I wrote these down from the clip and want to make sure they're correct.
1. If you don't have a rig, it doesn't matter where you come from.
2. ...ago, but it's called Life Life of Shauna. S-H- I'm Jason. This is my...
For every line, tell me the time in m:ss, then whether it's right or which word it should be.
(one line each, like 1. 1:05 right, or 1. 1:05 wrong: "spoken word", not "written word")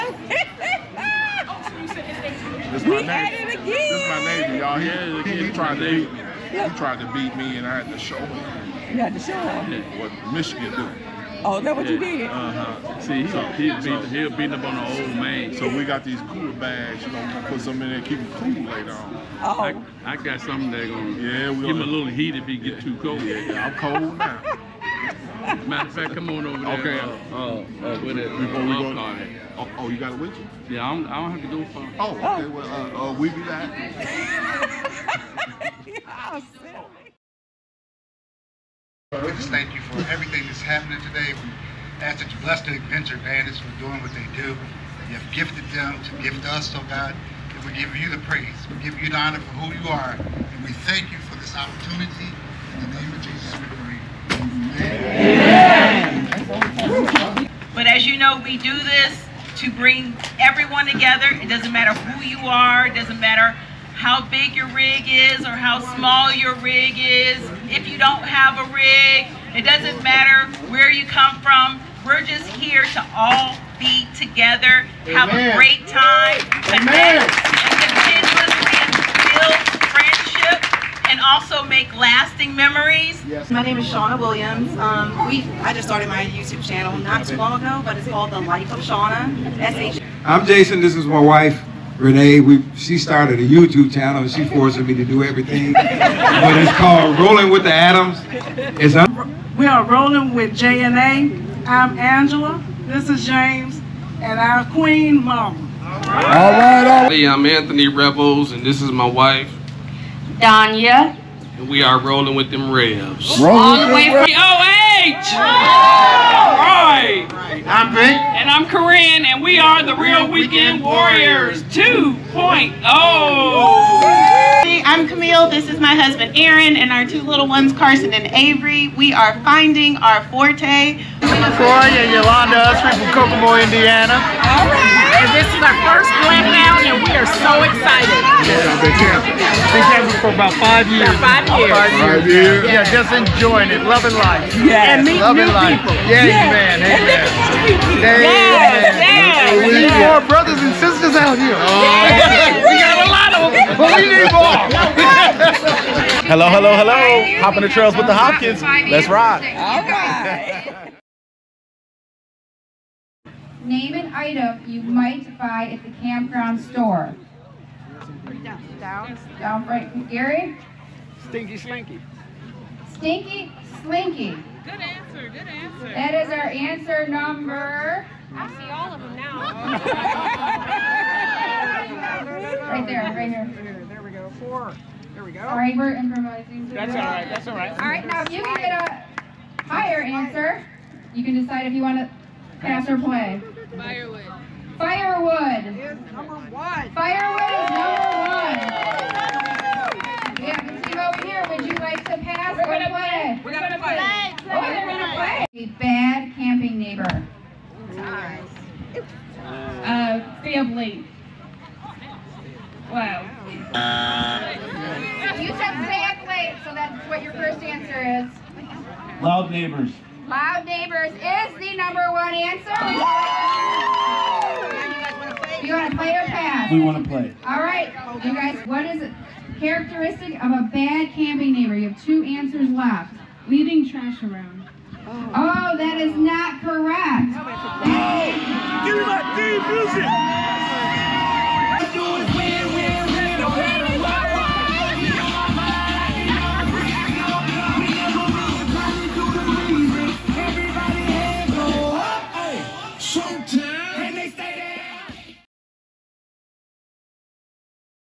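1. 1:07 right
2. 1:27 wrong: "The", not "Life".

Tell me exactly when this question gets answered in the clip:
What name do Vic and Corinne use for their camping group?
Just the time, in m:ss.
1:59.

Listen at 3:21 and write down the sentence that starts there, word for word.
Would you like to pass we're or gonna play?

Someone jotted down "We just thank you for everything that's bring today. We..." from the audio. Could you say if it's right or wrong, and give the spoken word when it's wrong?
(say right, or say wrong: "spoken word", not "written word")
wrong: "happening", not "bring".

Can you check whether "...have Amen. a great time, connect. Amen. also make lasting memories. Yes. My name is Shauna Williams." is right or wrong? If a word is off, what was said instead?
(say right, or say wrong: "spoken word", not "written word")
right.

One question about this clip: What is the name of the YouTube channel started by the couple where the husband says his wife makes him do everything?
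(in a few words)
Rolling with the Adams.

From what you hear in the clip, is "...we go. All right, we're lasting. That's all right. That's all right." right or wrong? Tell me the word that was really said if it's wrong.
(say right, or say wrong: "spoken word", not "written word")
wrong: "improvising", not "lasting".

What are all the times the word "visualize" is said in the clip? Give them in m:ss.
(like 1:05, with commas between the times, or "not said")
not said.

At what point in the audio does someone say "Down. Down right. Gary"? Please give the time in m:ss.
2:48.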